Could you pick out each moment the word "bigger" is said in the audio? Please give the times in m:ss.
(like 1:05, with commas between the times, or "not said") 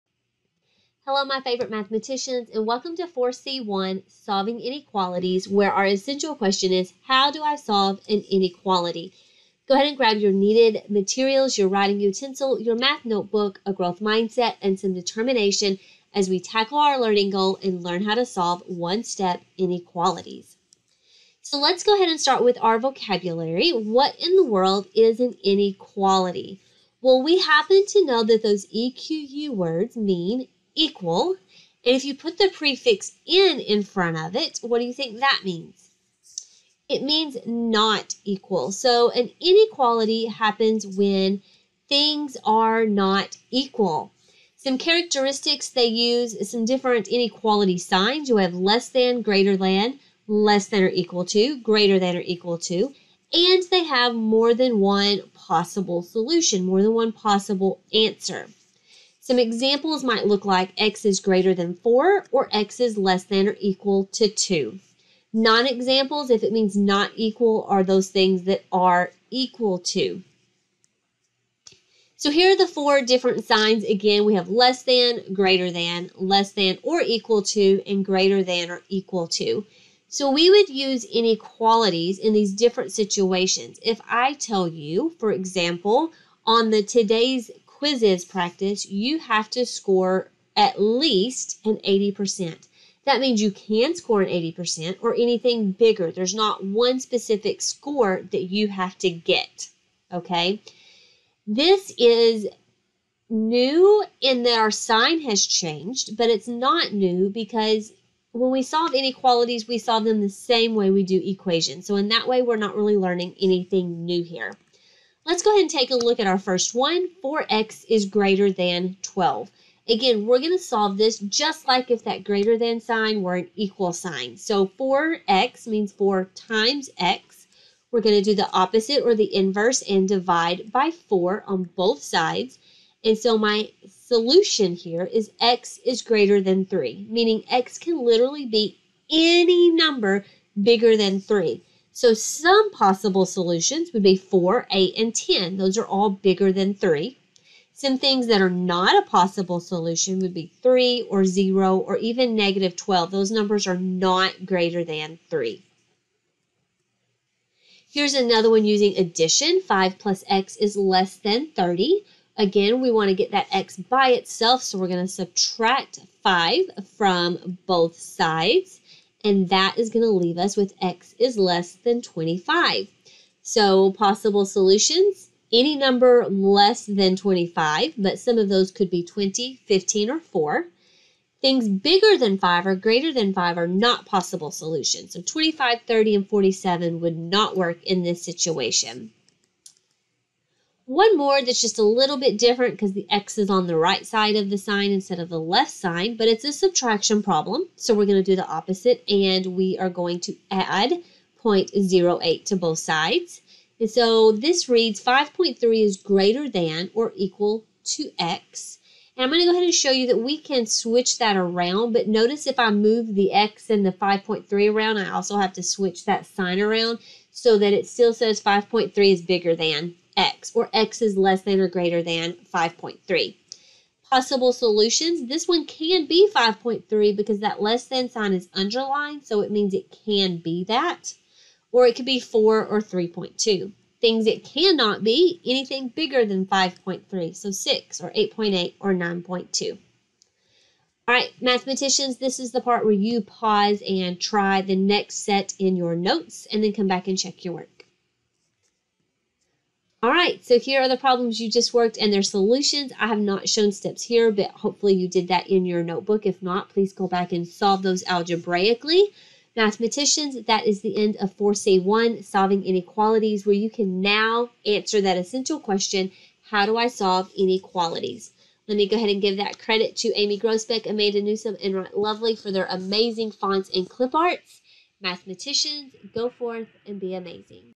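1:35, 2:20, 2:26, 3:01, 3:39, 3:55.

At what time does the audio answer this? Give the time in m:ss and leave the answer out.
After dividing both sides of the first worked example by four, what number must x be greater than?
2:15.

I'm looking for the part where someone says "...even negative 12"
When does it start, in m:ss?
2:31.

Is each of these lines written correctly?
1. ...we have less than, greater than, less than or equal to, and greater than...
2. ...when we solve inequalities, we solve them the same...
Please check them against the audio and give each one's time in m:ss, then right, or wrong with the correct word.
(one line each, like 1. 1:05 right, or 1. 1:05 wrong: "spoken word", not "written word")
1. 1:14 right
2. 1:48 right.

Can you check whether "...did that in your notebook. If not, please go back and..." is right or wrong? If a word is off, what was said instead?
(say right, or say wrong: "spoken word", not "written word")
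right.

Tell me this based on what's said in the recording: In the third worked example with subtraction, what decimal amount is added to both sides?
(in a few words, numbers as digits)
0.08.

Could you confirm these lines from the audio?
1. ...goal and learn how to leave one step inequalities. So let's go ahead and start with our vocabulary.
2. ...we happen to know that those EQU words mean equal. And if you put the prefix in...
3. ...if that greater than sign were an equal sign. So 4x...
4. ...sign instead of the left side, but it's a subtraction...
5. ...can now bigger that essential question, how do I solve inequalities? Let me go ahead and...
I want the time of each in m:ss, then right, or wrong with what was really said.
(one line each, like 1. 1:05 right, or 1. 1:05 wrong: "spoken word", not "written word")
1. 0:17 wrong: "solve", not "leave"
2. 0:27 right
3. 2:01 right
4. 3:14 right
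5. 4:23 wrong: "answer", not "bigger".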